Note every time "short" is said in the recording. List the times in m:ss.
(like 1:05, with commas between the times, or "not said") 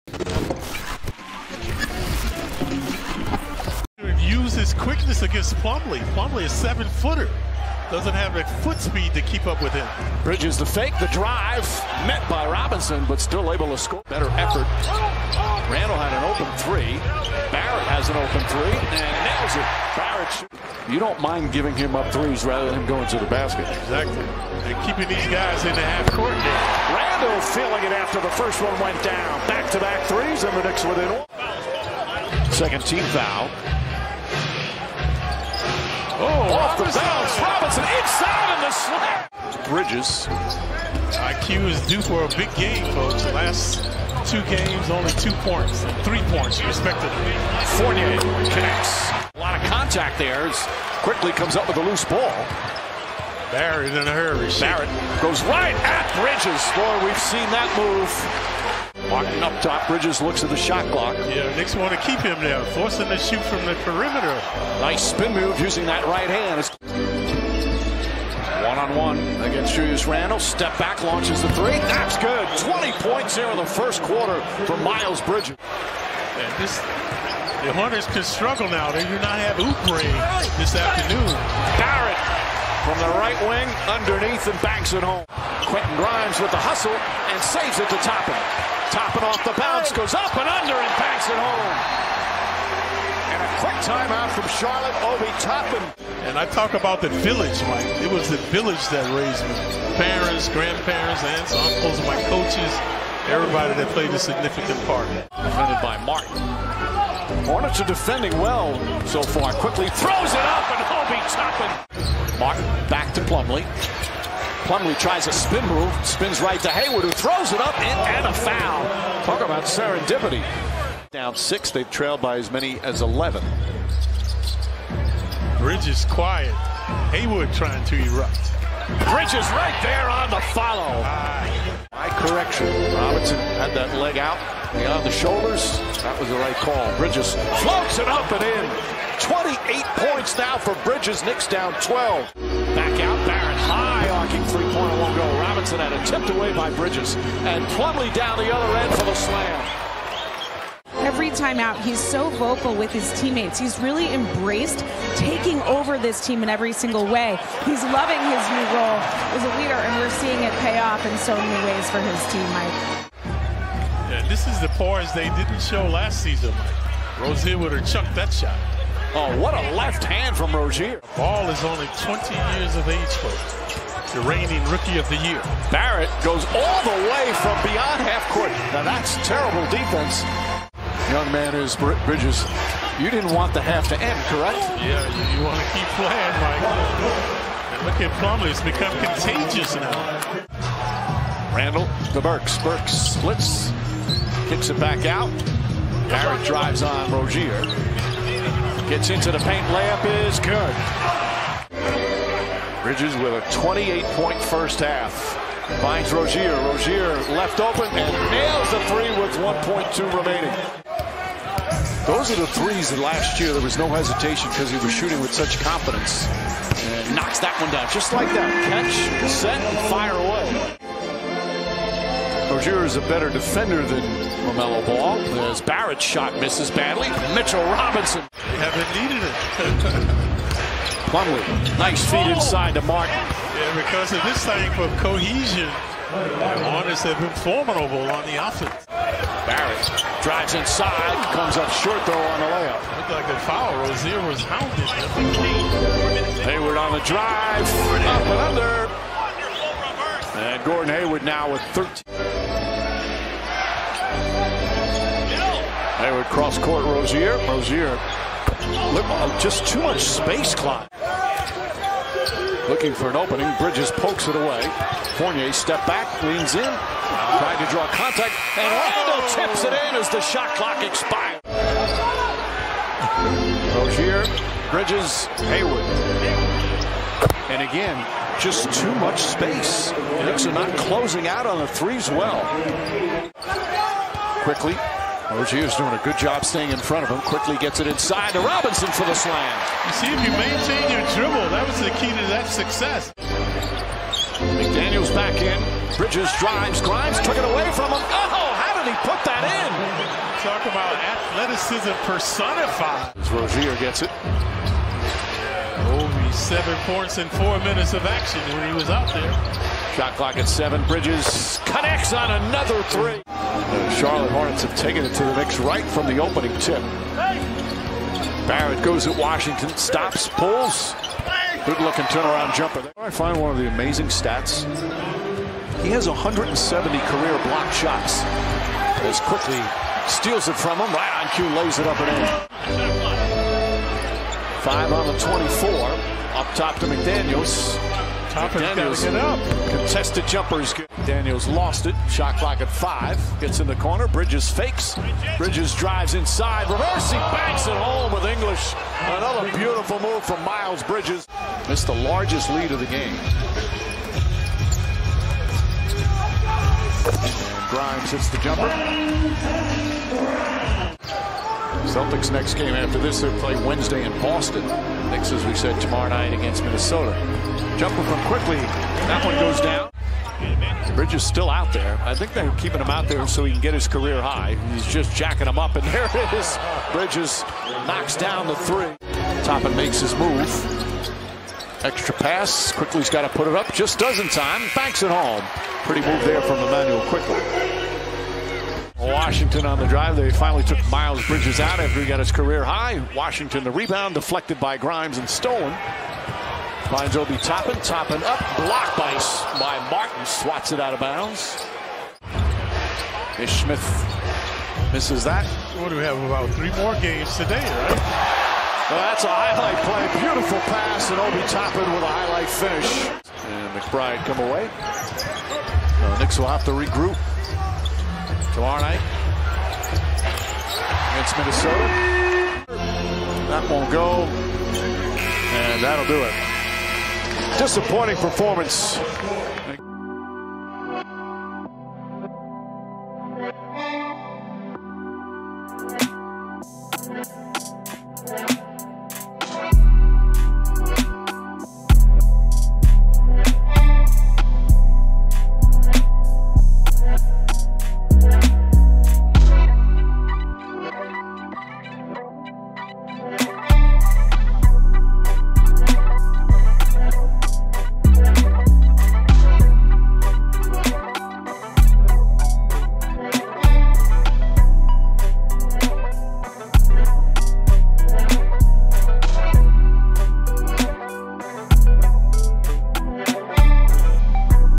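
4:01.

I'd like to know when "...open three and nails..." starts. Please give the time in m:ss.
0:18.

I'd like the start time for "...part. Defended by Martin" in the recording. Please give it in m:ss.
1:44.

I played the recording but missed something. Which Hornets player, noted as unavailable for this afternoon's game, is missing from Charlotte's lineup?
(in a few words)
Oubre.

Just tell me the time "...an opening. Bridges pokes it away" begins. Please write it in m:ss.
4:23.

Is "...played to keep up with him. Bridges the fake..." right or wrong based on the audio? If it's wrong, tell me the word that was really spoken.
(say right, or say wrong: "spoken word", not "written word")
wrong: "speed", not "played".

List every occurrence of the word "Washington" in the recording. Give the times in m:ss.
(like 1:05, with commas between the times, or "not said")
5:19, 6:28, 6:33.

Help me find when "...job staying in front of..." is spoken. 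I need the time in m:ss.
4:46.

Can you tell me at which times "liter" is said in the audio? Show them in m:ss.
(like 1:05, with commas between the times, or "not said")
not said.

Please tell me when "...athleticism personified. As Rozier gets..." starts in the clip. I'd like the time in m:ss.
5:00.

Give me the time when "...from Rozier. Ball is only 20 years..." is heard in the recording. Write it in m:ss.
2:50.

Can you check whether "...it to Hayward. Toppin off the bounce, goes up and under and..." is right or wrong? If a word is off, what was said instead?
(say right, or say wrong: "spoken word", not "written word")
wrong: "Toppin", not "Hayward".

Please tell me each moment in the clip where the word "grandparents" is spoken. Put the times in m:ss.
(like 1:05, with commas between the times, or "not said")
1:40.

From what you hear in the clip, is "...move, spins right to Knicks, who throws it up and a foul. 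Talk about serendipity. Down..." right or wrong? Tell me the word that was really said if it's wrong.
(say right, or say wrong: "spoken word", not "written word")
wrong: "Hayward", not "Knicks".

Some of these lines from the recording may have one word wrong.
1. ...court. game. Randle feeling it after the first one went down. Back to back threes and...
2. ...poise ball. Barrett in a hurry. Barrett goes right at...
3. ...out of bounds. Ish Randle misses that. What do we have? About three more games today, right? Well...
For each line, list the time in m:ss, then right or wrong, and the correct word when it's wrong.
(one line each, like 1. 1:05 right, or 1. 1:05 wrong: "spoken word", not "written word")
1. 0:26 right
2. 0:51 wrong: "loose", not "poise"
3. 6:40 wrong: "Smith", not "Randle".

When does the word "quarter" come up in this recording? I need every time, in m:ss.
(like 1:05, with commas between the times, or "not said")
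1:14.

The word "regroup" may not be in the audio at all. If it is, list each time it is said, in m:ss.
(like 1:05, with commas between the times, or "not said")
6:56.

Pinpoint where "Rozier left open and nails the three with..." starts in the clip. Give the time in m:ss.
3:26.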